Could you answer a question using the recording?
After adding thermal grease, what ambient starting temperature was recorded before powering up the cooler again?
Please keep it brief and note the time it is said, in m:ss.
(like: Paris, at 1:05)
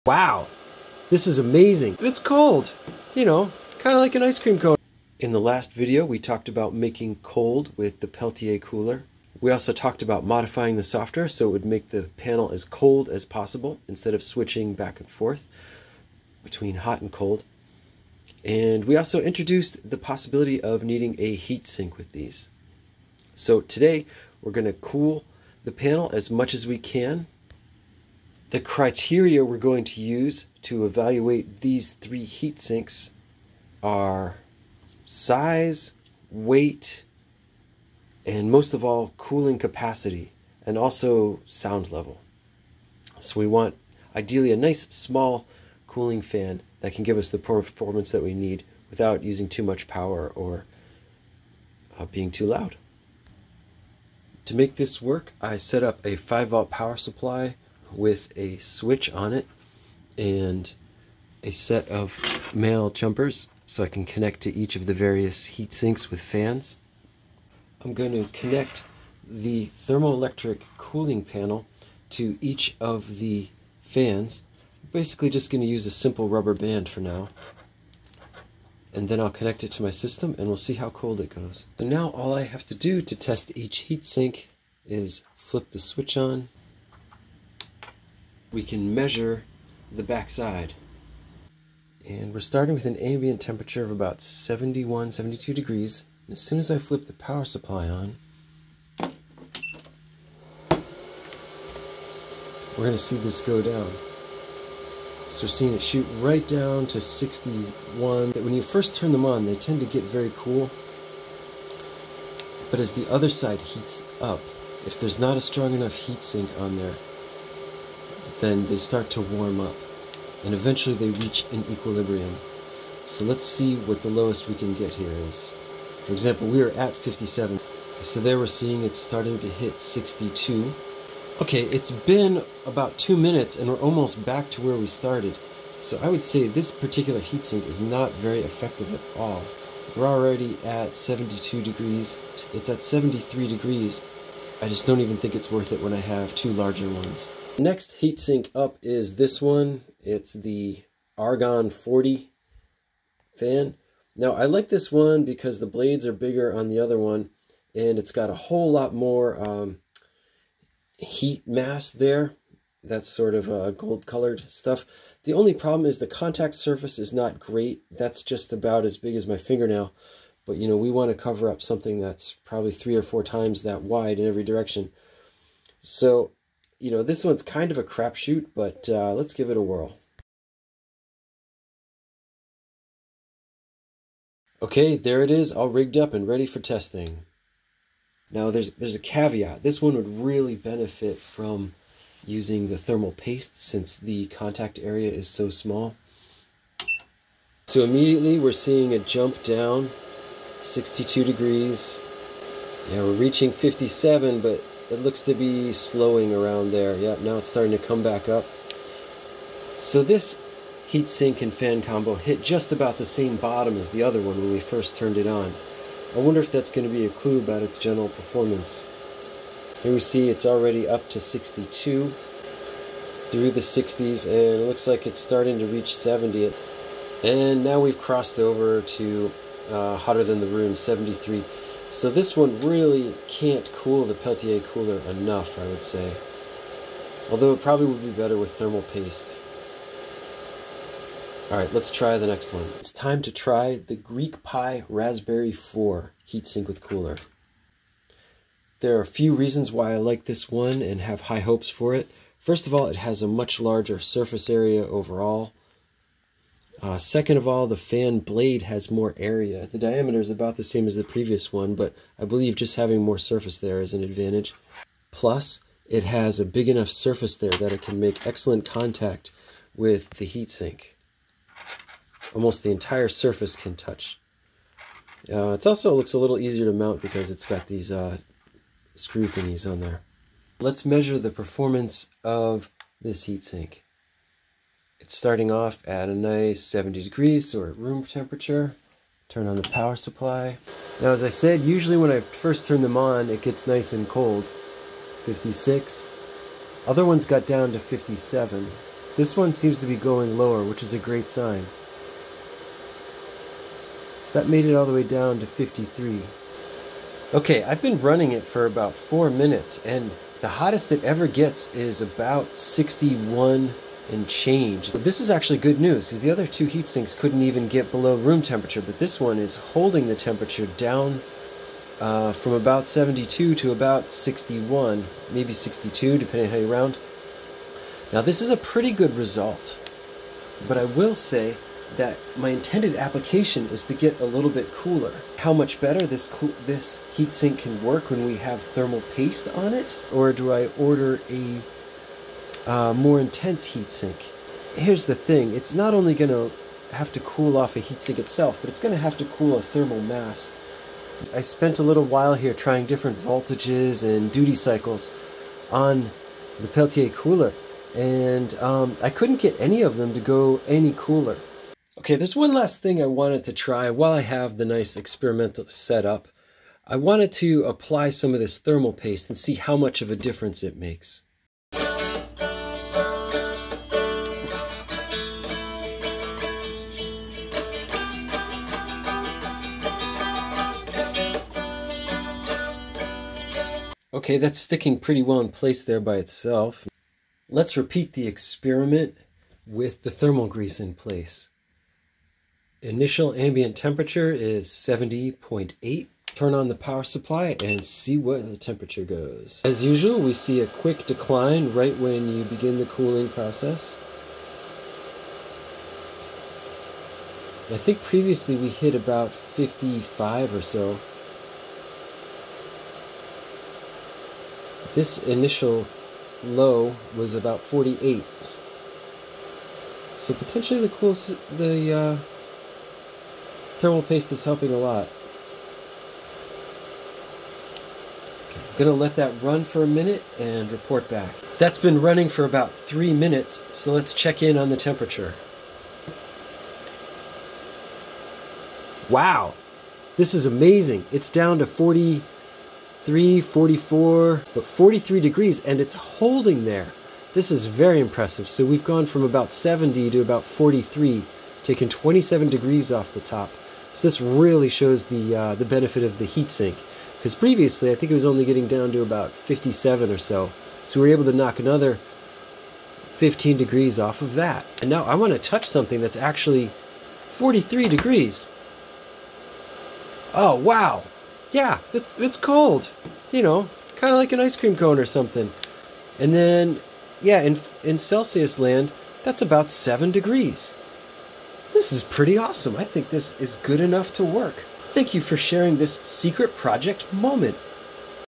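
70.8, at 6:34.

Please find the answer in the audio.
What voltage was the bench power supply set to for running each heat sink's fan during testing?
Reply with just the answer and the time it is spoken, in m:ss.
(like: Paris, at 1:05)
5 volts, at 0:56.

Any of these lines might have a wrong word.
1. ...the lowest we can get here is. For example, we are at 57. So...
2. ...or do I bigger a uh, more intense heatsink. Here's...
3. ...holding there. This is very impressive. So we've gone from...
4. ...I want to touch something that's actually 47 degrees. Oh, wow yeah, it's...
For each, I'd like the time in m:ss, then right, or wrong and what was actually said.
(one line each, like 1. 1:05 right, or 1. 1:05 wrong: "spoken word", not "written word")
1. 2:04 right
2. 5:40 wrong: "order", not "bigger"
3. 7:25 right
4. 7:45 wrong: "43", not "47".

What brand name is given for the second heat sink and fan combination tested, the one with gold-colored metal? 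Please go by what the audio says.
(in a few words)
Argon 40.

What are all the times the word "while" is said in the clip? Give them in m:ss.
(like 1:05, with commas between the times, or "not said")
5:52, 6:03.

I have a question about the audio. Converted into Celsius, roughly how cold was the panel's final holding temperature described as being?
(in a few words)
7 degrees.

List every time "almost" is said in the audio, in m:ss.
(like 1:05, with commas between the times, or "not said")
2:13, 4:32.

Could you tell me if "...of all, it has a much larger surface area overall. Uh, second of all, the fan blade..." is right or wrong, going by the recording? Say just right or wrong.
right.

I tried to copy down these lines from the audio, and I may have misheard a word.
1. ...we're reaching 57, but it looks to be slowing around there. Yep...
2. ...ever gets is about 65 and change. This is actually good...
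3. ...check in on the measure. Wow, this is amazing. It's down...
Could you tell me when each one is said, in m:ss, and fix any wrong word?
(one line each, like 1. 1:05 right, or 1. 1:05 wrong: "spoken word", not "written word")
1. 3:23 right
2. 5:11 wrong: "61", not "65"
3. 7:14 wrong: "temperature", not "measure".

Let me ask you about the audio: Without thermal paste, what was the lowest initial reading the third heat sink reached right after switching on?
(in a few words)
53.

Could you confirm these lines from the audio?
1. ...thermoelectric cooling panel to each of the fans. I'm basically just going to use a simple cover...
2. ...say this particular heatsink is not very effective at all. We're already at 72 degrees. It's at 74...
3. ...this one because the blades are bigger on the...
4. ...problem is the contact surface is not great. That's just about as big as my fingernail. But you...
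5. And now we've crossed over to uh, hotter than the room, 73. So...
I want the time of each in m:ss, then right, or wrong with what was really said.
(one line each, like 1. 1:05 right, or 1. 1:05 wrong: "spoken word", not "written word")
1. 1:09 wrong: "rubber", not "cover"
2. 2:16 wrong: "73", not "74"
3. 2:34 right
4. 2:45 right
5. 3:47 right.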